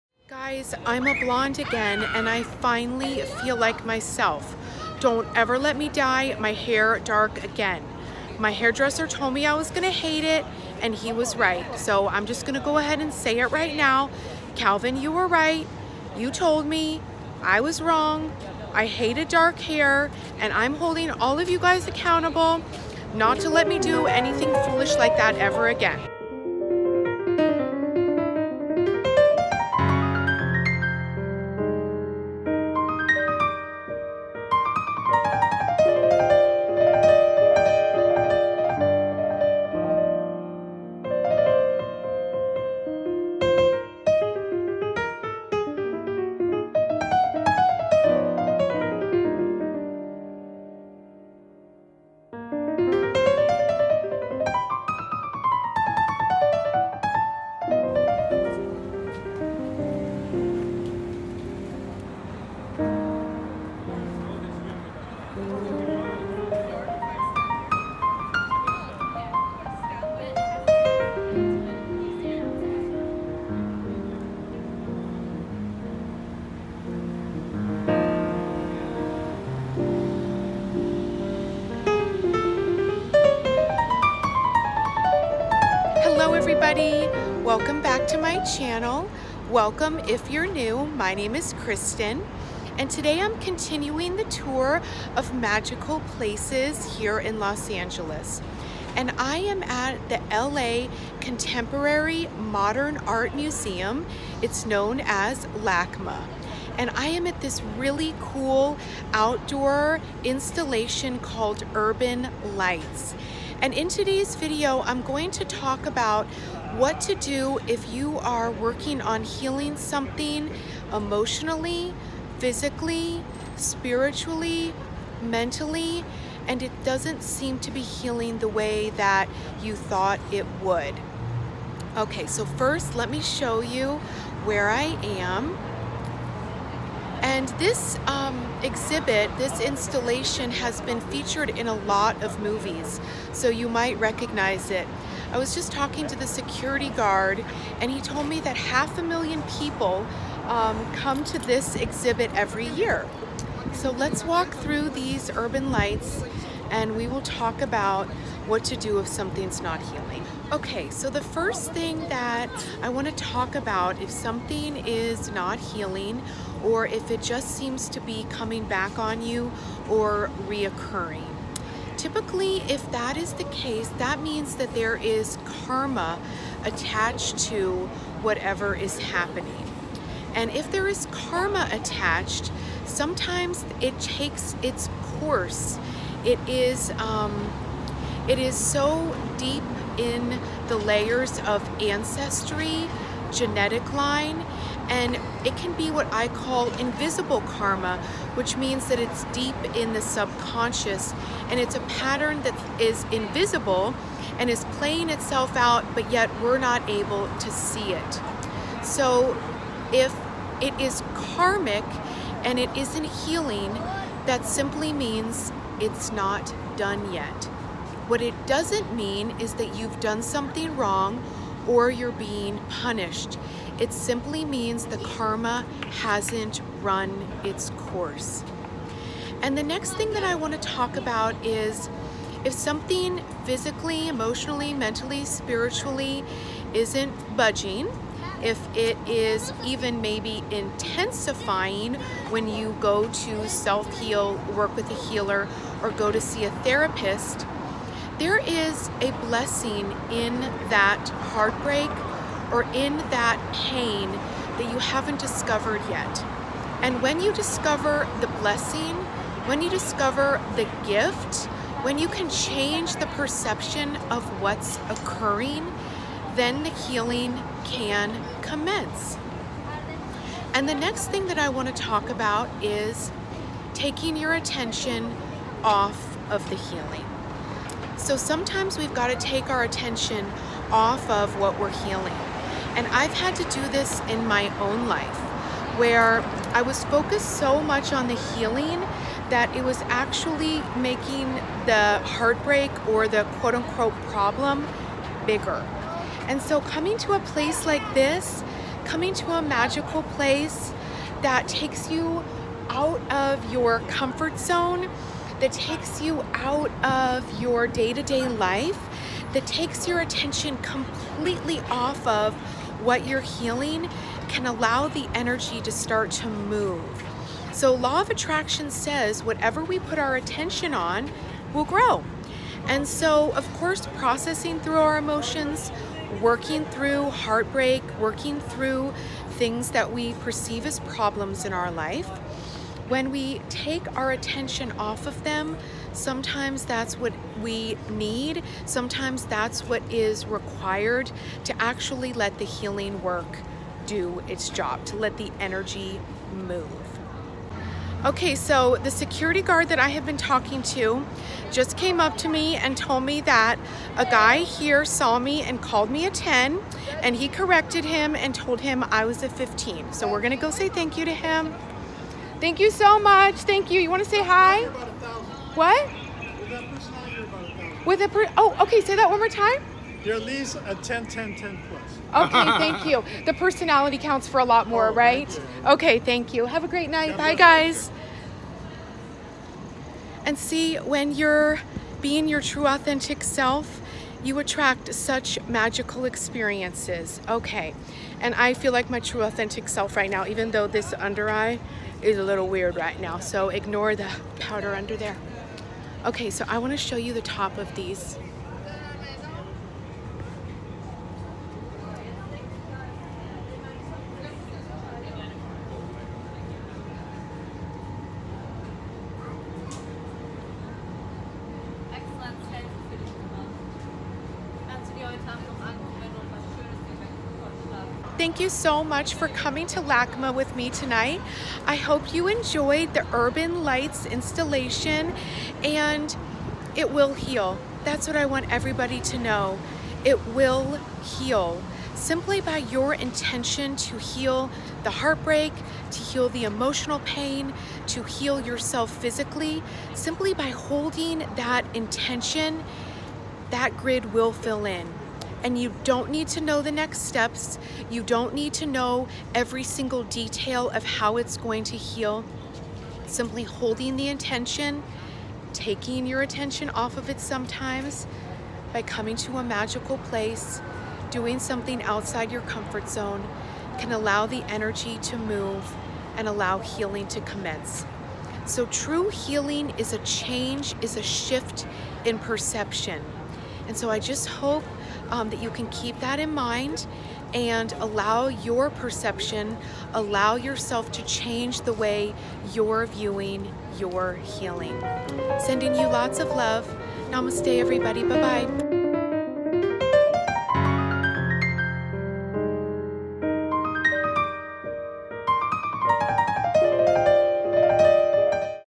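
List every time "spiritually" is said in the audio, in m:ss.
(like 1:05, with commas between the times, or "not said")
2:03, 3:55.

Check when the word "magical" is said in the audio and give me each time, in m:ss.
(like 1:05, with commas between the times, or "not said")
1:35, 4:59, 6:25, 7:39.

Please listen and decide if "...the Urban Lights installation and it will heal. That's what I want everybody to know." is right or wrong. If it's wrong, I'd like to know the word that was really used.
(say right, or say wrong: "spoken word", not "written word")
right.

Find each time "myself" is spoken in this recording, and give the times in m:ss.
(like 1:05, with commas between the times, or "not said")
0:03.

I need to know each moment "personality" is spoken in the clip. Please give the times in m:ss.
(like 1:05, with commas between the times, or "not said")
6:13.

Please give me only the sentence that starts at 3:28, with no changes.
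So if it is karmic and it isn't healing, that simply means it's not done yet.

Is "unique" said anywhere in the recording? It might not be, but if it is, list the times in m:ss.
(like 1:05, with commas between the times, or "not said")
not said.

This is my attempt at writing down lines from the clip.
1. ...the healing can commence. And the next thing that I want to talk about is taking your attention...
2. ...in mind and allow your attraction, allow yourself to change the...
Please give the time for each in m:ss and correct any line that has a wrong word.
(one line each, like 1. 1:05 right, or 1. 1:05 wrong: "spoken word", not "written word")
1. 4:26 right
2. 7:56 wrong: "perception", not "attraction".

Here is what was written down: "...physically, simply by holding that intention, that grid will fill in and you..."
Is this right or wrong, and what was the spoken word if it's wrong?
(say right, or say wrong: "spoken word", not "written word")
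right.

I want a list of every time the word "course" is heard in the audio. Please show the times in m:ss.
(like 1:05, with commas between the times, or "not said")
3:05, 3:47, 5:23.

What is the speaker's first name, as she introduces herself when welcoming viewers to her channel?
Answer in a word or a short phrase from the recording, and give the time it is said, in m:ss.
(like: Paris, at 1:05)
Kristen, at 1:31.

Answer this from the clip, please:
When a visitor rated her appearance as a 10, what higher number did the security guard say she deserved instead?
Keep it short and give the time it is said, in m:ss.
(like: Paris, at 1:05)
15, at 5:59.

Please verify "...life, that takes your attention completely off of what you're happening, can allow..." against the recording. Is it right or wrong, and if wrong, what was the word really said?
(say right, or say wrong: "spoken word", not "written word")
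wrong: "healing", not "happening".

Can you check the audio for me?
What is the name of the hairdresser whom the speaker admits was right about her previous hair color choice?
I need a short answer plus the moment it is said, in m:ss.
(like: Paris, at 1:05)
Calvin, at 0:14.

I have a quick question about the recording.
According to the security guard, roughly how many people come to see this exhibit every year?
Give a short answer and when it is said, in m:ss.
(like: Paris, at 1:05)
half a million, at 2:28.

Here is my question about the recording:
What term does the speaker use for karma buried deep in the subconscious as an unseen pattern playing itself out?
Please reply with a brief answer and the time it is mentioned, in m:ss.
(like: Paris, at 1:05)
invisible karma, at 3:16.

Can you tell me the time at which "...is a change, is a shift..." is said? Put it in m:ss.
7:49.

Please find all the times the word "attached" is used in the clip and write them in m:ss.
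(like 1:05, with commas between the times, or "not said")
2:56, 3:01.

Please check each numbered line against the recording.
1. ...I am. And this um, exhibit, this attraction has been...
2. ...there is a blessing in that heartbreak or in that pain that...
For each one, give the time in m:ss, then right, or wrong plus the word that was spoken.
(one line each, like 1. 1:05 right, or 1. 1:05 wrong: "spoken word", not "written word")
1. 2:14 wrong: "installation", not "attraction"
2. 4:08 right.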